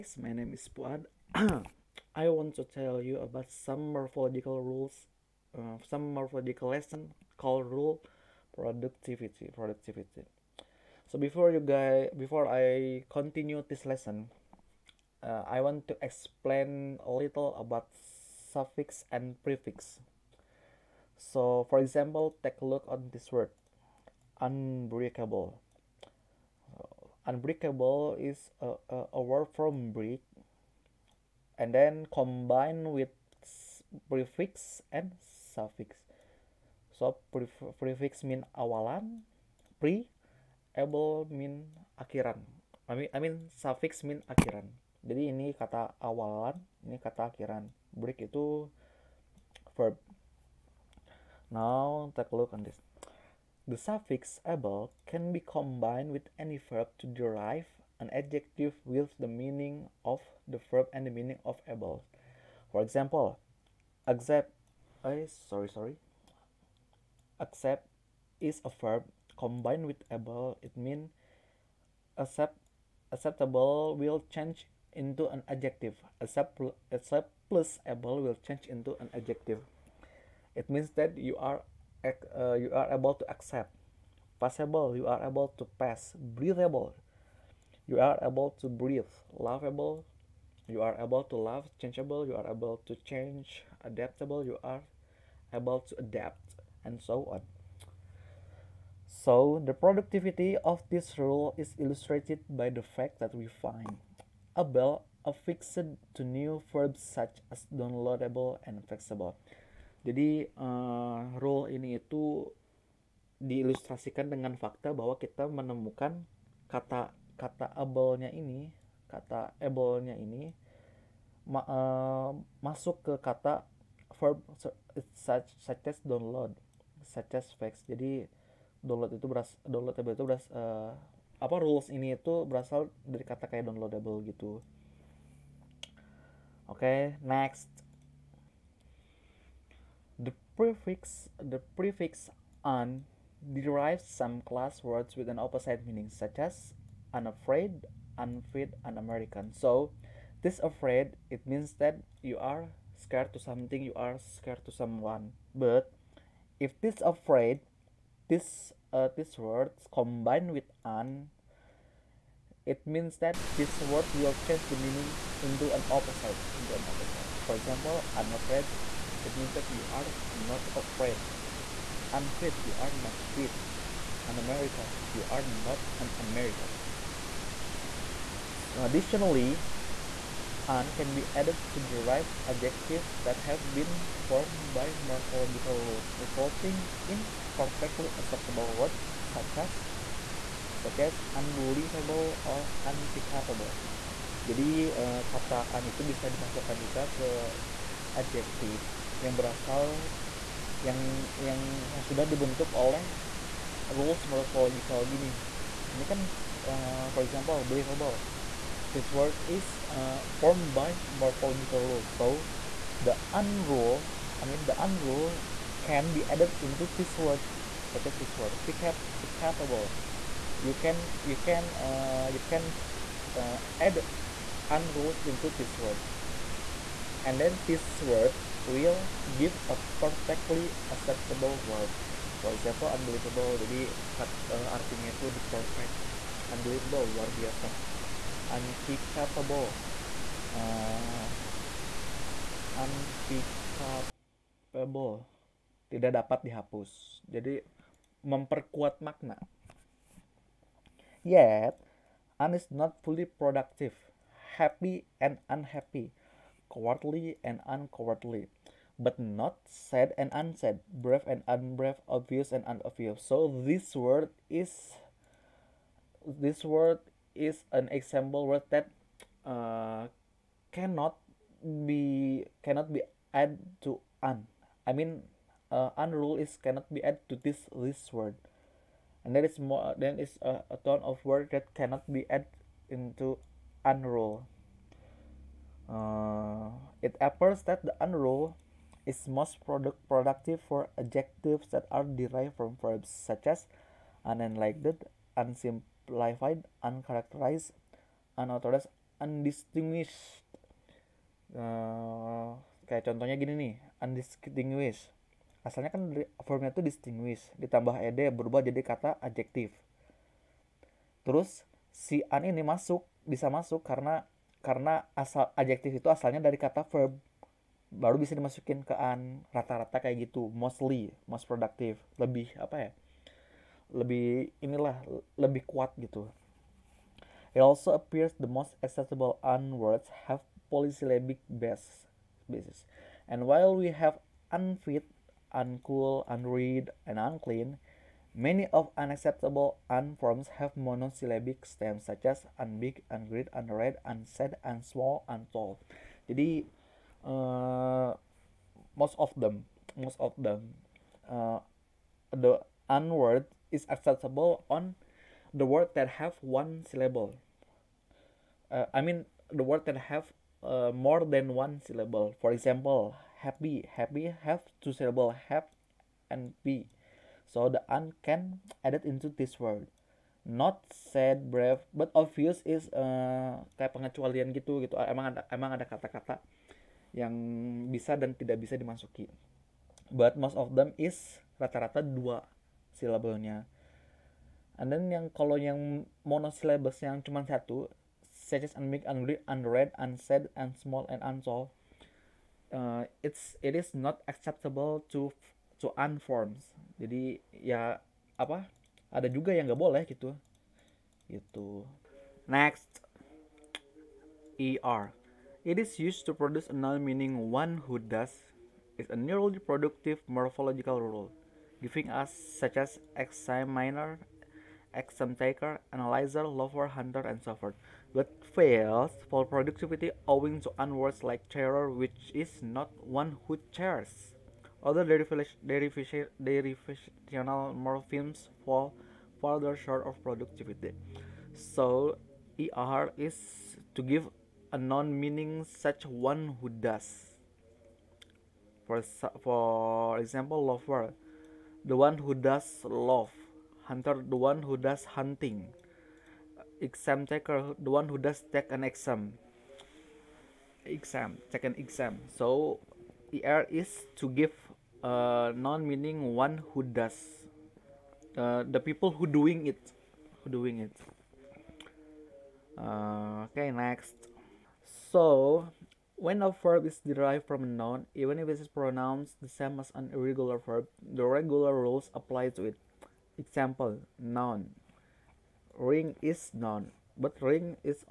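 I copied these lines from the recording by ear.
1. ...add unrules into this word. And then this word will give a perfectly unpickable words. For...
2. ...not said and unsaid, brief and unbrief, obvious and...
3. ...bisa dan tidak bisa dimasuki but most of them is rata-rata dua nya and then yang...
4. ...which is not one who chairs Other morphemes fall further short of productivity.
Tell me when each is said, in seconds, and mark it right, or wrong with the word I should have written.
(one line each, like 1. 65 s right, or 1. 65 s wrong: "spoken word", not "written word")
1. 223 s wrong: "acceptable", not "unpickable"
2. 259 s right
3. 377 s right
4. 421 s right.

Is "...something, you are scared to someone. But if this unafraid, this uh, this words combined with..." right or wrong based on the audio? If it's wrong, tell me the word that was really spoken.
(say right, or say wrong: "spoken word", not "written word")
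wrong: "afraid", not "unafraid".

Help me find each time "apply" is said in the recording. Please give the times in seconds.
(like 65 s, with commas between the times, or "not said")
472 s.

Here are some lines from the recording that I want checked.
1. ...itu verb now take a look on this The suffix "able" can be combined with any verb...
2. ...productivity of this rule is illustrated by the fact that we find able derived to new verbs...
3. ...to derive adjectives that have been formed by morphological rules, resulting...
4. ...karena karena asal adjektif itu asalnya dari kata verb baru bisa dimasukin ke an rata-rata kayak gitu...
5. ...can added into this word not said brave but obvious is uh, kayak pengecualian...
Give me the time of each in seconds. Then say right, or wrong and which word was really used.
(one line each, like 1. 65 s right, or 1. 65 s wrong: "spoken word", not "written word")
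1. 48 s right
2. 99 s wrong: "affixed", not "derived"
3. 181 s right
4. 313 s right
5. 368 s right.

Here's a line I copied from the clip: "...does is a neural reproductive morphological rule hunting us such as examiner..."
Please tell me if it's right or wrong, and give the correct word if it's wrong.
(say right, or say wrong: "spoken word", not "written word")
wrong: "giving", not "hunting".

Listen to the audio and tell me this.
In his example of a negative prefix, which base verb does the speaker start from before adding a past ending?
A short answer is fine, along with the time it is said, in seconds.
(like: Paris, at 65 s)
distinguish, at 306 s.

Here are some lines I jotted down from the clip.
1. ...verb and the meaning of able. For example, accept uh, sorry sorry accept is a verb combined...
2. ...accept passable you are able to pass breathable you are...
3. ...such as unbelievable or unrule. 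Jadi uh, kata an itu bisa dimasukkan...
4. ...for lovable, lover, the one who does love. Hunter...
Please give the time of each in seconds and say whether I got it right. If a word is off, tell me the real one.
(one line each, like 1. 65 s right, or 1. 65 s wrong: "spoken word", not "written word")
1. 60 s right
2. 83 s right
3. 190 s wrong: "unpickable", not "unrule"
4. 439 s wrong: "example", not "lovable".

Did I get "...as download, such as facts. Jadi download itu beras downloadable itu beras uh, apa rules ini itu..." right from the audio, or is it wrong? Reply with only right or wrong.
right.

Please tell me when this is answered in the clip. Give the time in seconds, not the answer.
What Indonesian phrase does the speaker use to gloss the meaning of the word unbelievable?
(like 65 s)
237 s.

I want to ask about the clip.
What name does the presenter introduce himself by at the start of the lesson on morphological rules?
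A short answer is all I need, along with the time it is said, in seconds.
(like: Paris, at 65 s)
Puad, at 0 s.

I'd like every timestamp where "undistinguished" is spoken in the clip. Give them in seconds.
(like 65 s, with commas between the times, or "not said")
299 s, 304 s.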